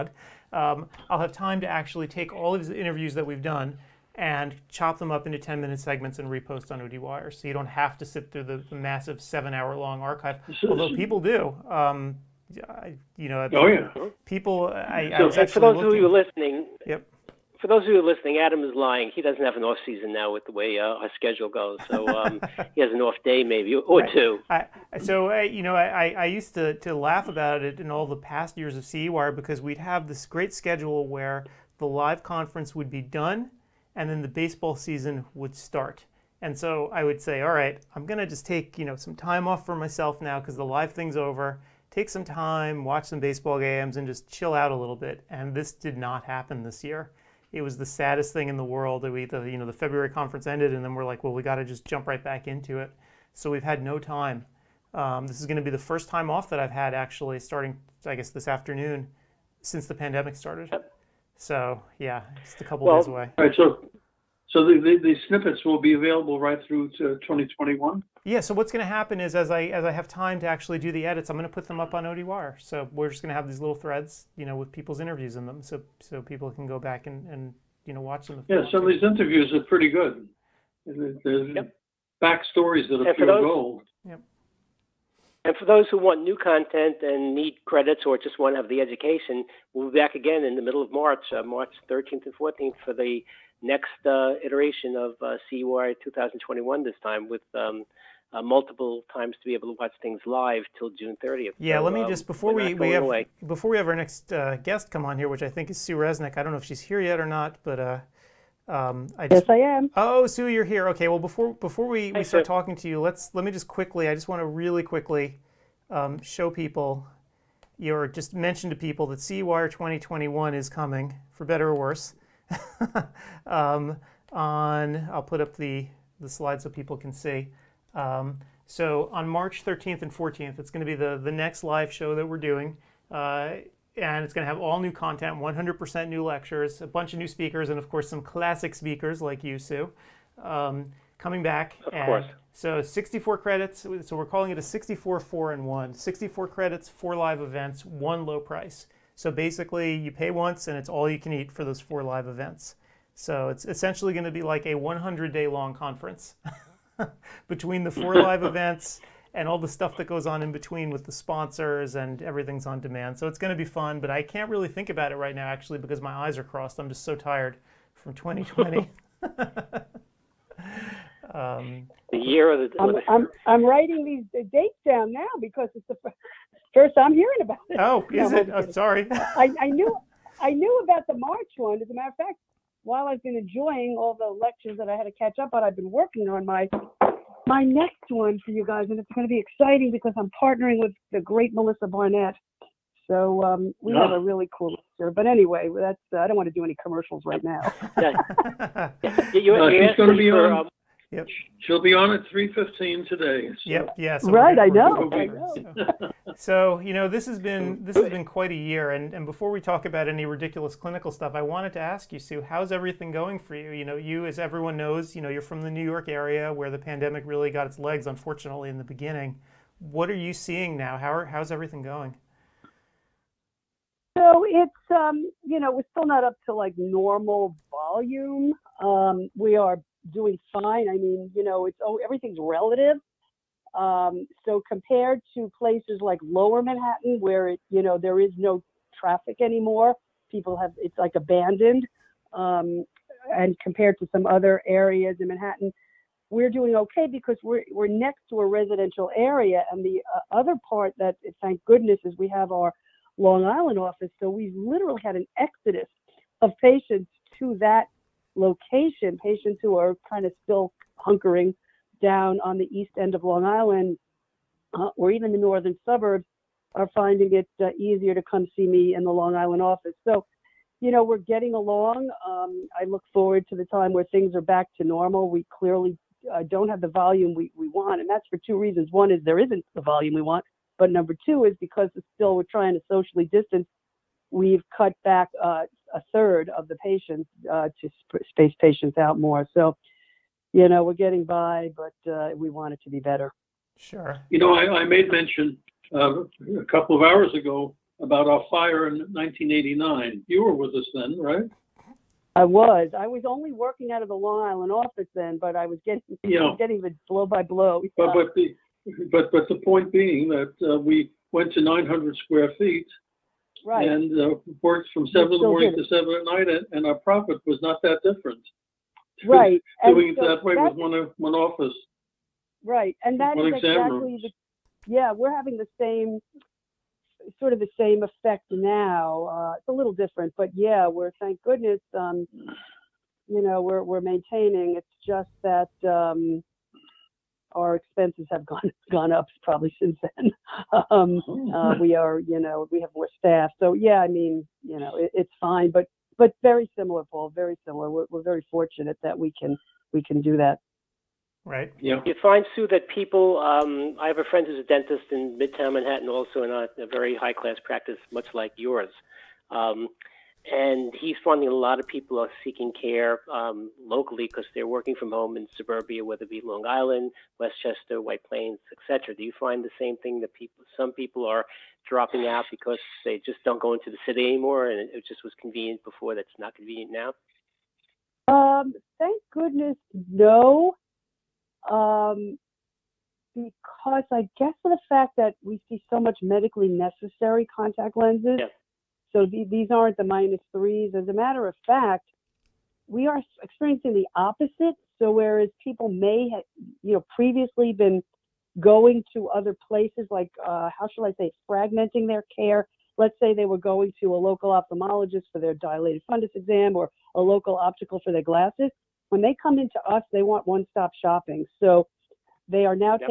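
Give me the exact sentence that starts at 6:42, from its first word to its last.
Let's say they were going to a local ophthalmologist for their dilated fundus exam or a local optical for their glasses.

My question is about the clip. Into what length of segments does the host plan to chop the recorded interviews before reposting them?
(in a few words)
10 minute.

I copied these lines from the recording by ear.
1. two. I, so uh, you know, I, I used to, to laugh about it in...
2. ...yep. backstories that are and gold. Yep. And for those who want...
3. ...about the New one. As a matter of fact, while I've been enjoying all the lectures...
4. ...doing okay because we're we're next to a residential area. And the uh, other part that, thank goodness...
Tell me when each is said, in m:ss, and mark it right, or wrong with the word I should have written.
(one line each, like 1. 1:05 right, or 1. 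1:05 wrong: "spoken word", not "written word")
1. 0:24 right
2. 1:21 right
3. 3:00 wrong: "March", not "New"
4. 4:06 right.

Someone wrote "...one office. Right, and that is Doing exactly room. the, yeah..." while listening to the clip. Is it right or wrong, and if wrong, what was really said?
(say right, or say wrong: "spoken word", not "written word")
wrong: "One", not "Doing".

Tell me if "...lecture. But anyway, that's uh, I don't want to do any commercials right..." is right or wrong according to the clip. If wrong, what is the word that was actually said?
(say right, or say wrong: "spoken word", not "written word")
right.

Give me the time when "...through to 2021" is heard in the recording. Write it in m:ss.
1:06.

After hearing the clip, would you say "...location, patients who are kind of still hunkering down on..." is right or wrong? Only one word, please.
right.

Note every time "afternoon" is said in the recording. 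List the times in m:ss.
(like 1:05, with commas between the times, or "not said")
0:58.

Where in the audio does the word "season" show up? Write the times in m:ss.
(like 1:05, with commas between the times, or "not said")
0:19, 0:34.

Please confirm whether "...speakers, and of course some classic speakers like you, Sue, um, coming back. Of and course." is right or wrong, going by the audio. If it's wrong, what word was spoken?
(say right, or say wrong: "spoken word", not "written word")
right.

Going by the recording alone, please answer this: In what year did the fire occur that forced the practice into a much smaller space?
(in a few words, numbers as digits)
1989.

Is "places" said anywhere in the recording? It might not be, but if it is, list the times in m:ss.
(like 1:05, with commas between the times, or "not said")
3:55, 6:39.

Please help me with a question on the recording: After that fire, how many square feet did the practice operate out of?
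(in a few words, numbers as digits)
900.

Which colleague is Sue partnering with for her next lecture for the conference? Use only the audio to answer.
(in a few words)
Melissa Barnett.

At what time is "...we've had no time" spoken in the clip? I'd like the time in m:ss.
0:53.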